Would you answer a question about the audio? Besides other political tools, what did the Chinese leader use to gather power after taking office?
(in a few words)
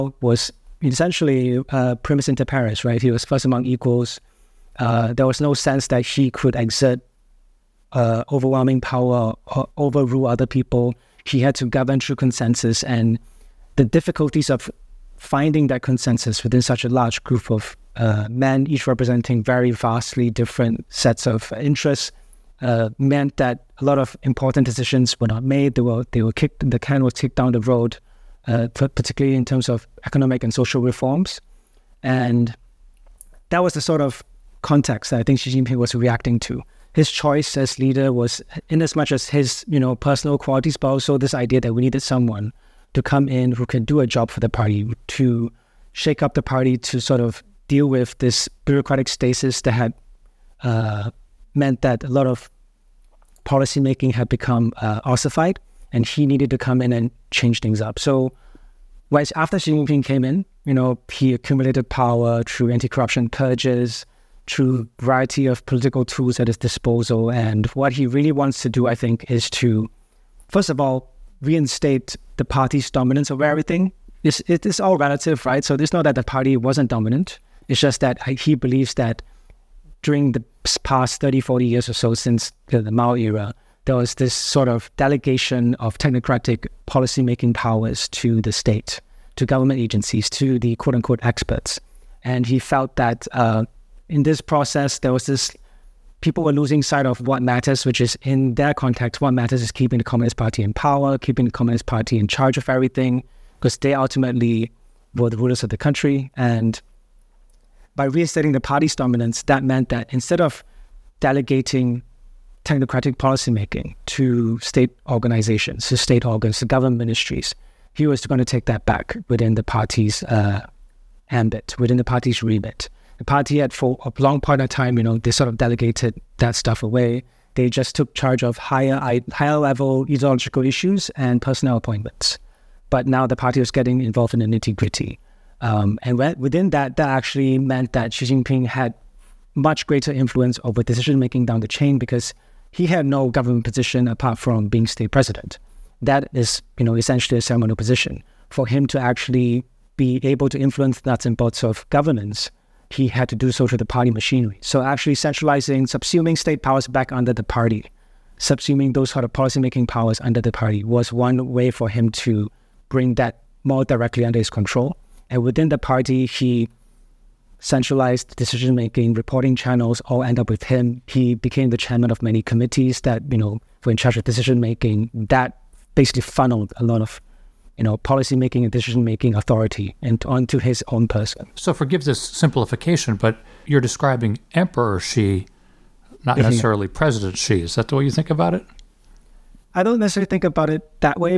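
anti-corruption purges.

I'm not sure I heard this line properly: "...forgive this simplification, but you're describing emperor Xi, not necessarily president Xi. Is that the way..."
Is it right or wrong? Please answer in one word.
right.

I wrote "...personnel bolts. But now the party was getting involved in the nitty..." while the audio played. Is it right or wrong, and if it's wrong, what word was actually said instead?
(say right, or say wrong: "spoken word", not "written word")
wrong: "appointments", not "bolts".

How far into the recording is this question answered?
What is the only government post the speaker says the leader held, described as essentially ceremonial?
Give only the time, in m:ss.
2:24.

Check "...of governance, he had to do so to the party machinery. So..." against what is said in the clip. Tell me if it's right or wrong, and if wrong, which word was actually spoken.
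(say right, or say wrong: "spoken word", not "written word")
right.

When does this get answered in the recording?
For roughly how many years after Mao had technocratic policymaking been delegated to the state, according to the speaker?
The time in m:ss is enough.
1:21.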